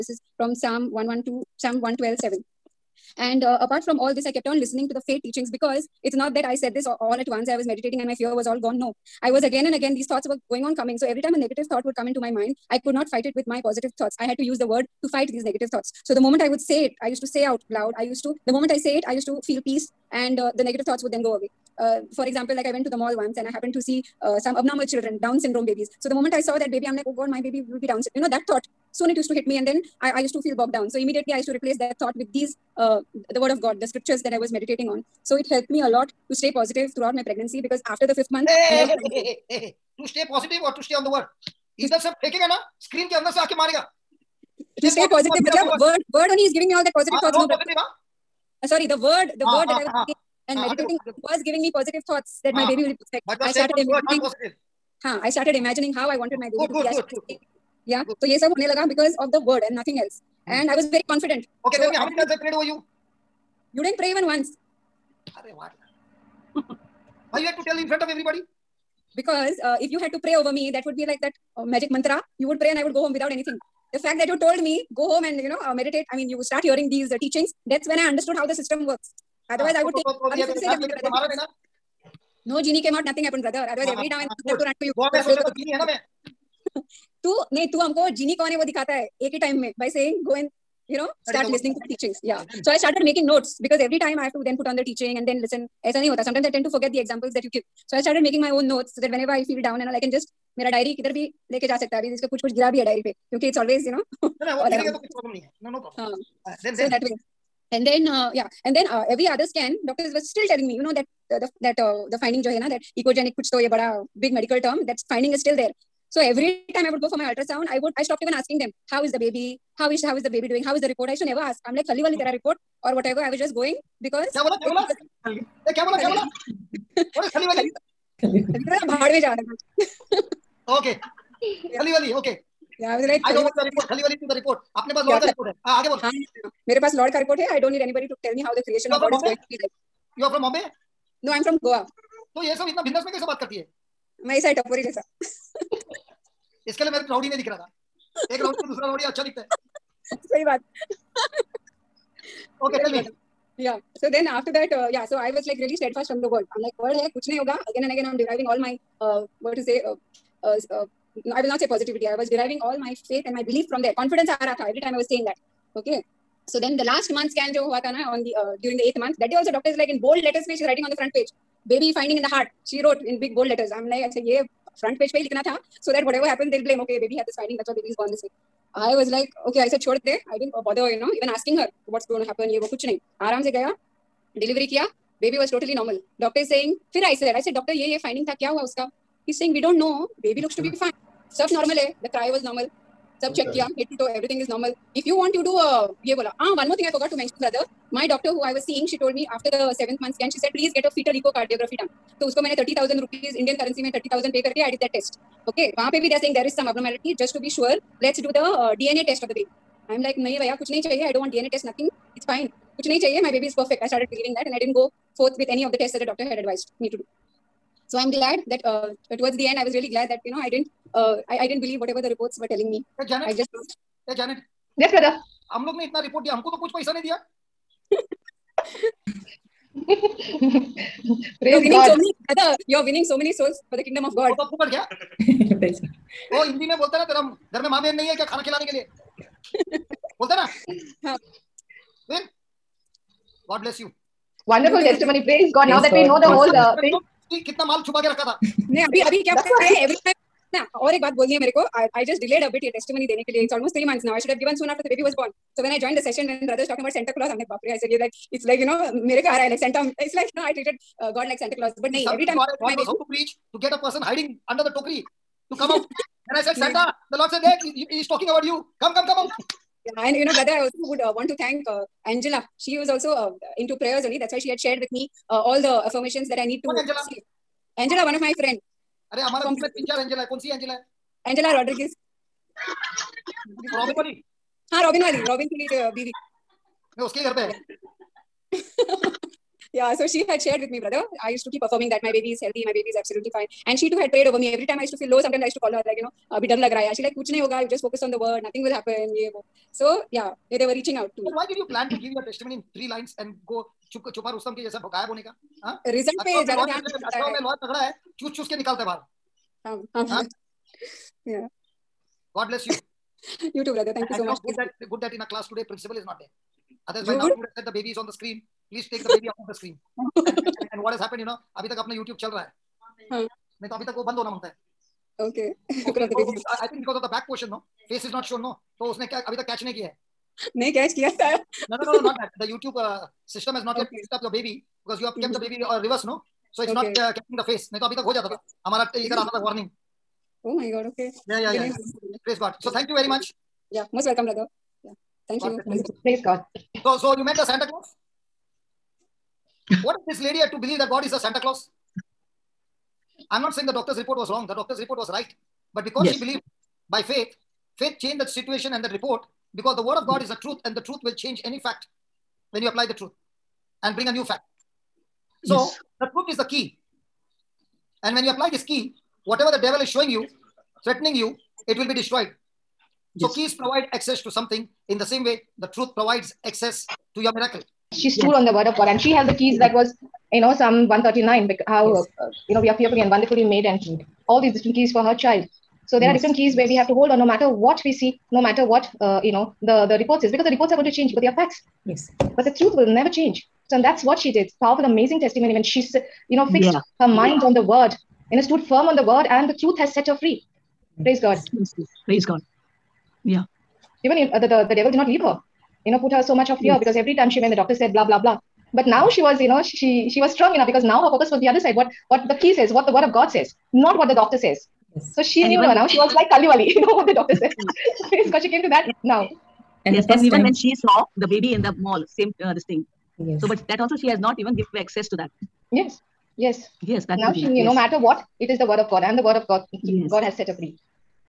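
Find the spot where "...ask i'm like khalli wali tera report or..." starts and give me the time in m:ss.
2:01.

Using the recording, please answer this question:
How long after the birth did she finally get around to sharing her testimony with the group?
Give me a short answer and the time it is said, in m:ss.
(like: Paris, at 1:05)
3 months, at 4:13.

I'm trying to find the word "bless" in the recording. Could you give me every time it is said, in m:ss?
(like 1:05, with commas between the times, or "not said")
4:03, 5:12.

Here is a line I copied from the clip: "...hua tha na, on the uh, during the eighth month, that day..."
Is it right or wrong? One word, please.
right.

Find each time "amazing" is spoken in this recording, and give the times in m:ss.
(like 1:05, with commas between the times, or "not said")
6:34.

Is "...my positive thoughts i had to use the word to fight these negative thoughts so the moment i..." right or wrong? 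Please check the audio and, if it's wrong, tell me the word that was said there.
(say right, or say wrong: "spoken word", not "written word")
right.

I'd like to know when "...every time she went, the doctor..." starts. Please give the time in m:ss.
6:46.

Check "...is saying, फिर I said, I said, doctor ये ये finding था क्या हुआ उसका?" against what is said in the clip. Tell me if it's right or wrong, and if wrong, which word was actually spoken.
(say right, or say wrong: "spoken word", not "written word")
right.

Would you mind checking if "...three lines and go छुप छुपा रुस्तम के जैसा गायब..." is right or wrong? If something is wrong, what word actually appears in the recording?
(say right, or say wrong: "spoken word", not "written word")
right.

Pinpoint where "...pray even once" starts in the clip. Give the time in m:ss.
1:03.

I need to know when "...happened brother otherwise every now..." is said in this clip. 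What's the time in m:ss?
1:23.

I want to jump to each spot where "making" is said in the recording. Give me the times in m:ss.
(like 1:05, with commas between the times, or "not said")
1:33, 1:38.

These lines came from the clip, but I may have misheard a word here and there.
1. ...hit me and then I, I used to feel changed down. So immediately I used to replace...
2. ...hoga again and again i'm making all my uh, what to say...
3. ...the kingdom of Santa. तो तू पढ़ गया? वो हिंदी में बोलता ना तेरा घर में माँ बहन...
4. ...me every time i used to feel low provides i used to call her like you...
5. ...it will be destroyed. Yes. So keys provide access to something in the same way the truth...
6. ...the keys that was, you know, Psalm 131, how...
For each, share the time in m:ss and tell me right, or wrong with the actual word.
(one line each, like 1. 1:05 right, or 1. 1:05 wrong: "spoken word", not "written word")
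1. 0:29 wrong: "bogged", not "changed"
2. 2:37 wrong: "deriving", not "making"
3. 3:53 wrong: "God", not "Santa"
4. 4:54 wrong: "sometimes", not "provides"
5. 6:11 right
6. 6:19 wrong: "139", not "131".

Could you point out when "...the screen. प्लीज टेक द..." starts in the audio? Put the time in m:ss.
5:18.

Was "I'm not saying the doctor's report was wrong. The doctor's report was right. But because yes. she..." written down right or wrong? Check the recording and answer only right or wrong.
right.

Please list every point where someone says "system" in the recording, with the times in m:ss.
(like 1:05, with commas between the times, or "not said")
1:18, 5:33.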